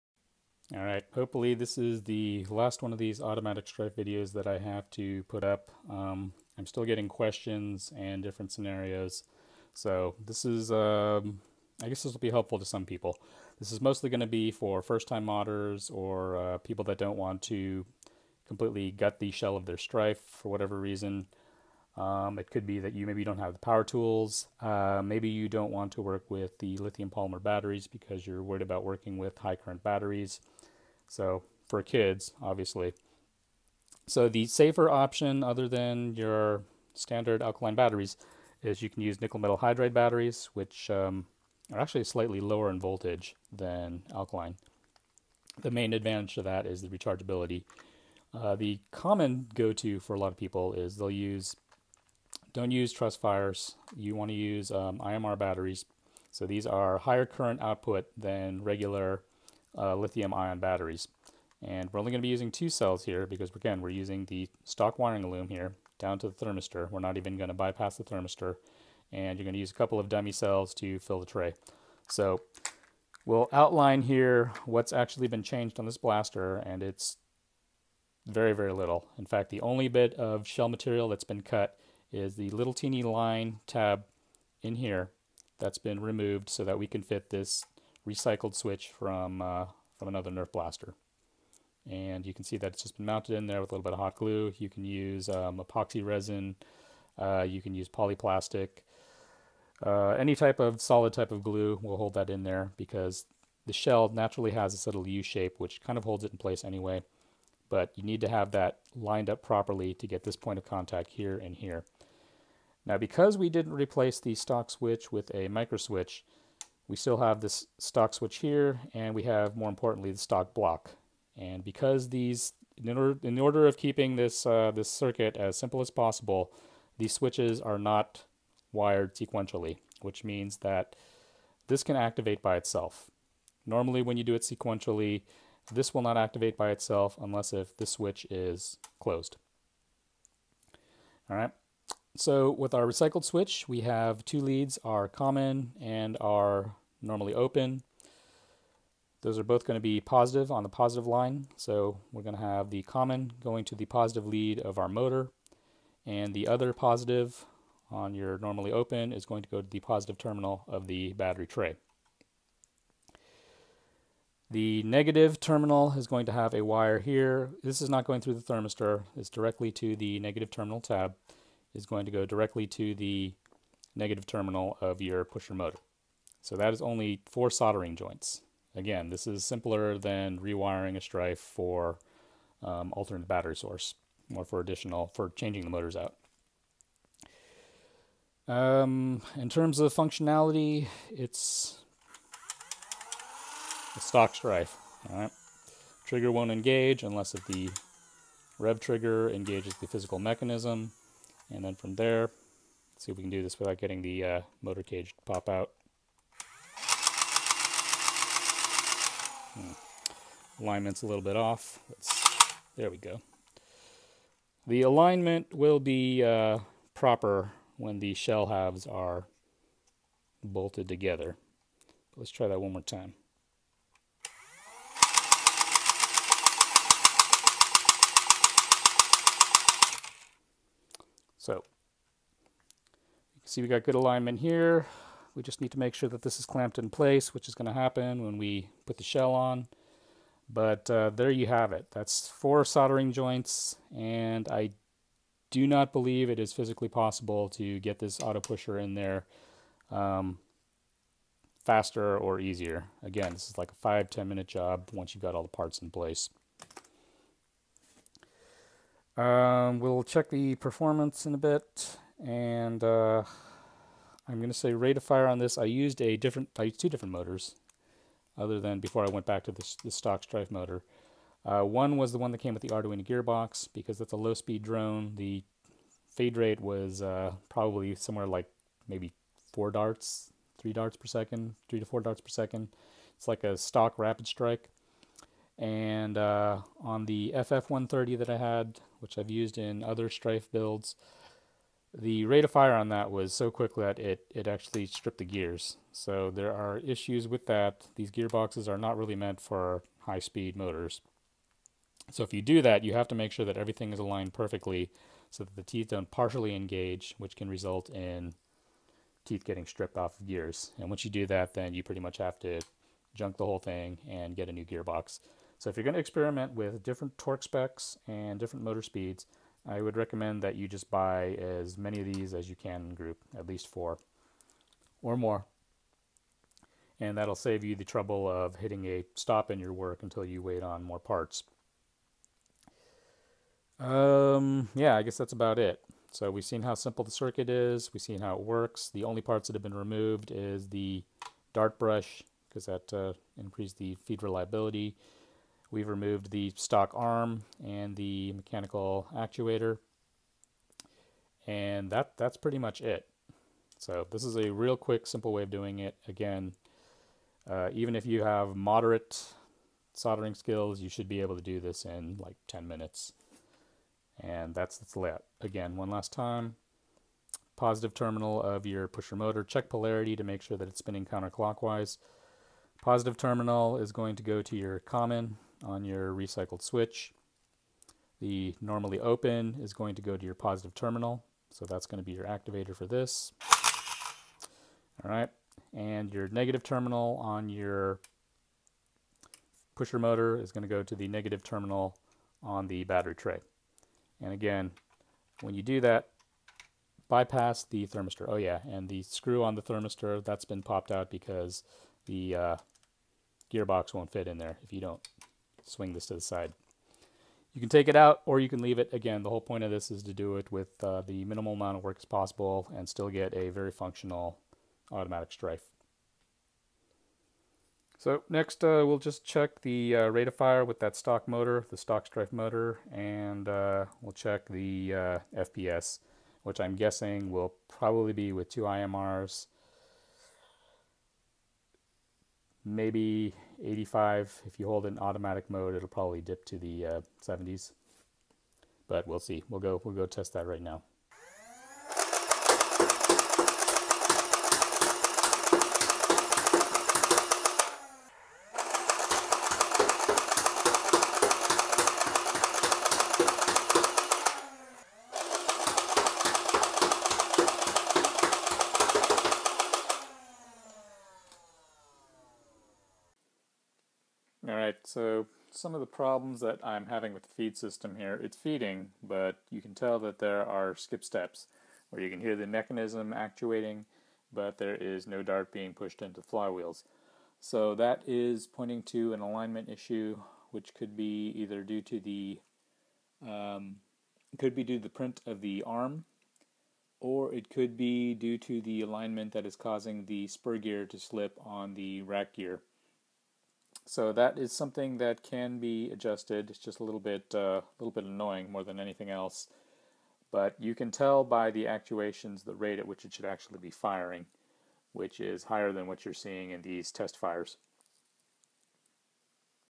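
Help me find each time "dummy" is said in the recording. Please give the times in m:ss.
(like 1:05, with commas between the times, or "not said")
1:10.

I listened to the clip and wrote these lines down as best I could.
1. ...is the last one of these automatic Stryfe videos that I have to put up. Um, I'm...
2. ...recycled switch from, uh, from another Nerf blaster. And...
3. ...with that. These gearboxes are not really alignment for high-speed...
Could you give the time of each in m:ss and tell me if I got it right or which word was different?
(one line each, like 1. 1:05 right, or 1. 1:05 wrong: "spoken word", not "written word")
1. 0:01 right
2. 1:28 right
3. 4:57 wrong: "meant", not "alignment".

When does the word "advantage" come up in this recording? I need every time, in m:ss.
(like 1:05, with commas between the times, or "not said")
0:45.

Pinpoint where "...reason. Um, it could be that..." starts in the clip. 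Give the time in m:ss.
0:20.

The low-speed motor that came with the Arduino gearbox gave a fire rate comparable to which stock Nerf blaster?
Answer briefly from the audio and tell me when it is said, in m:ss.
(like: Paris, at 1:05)
Rapidstrike, at 4:43.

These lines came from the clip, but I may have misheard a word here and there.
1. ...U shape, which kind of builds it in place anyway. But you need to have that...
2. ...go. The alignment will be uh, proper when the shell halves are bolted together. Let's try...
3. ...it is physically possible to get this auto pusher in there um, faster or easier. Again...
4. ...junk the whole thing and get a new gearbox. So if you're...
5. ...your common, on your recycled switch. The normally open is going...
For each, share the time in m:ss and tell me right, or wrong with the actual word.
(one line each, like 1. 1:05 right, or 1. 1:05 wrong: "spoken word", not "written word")
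1. 1:45 wrong: "holds", not "builds"
2. 3:32 right
3. 4:06 right
4. 5:13 right
5. 6:14 right.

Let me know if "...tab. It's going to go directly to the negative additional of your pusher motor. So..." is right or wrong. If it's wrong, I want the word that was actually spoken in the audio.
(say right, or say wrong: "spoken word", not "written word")
wrong: "terminal", not "additional".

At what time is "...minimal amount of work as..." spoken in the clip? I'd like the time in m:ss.
6:51.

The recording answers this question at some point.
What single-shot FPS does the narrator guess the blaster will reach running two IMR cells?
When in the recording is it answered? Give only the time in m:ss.
7:13.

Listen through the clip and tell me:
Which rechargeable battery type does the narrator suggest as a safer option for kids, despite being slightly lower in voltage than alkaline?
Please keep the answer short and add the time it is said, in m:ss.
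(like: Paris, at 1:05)
nickel metal hydride, at 0:39.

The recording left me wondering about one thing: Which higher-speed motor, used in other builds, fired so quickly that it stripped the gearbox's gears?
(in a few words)
FF130.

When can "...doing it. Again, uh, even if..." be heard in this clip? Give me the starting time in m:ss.
5:55.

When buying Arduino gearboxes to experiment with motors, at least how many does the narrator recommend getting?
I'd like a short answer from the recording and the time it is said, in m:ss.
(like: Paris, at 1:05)
4, at 5:23.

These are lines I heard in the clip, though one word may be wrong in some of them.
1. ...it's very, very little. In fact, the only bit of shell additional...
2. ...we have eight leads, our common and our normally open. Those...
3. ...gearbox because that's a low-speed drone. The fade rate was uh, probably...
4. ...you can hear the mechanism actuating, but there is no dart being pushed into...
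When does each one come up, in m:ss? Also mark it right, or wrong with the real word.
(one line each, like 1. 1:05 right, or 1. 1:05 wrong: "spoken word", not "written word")
1. 1:16 wrong: "material", not "additional"
2. 2:23 wrong: "two", not "eight"
3. 4:33 right
4. 7:52 right.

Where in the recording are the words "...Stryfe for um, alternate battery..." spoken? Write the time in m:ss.
3:00.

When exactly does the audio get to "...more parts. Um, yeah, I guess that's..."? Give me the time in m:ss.
5:30.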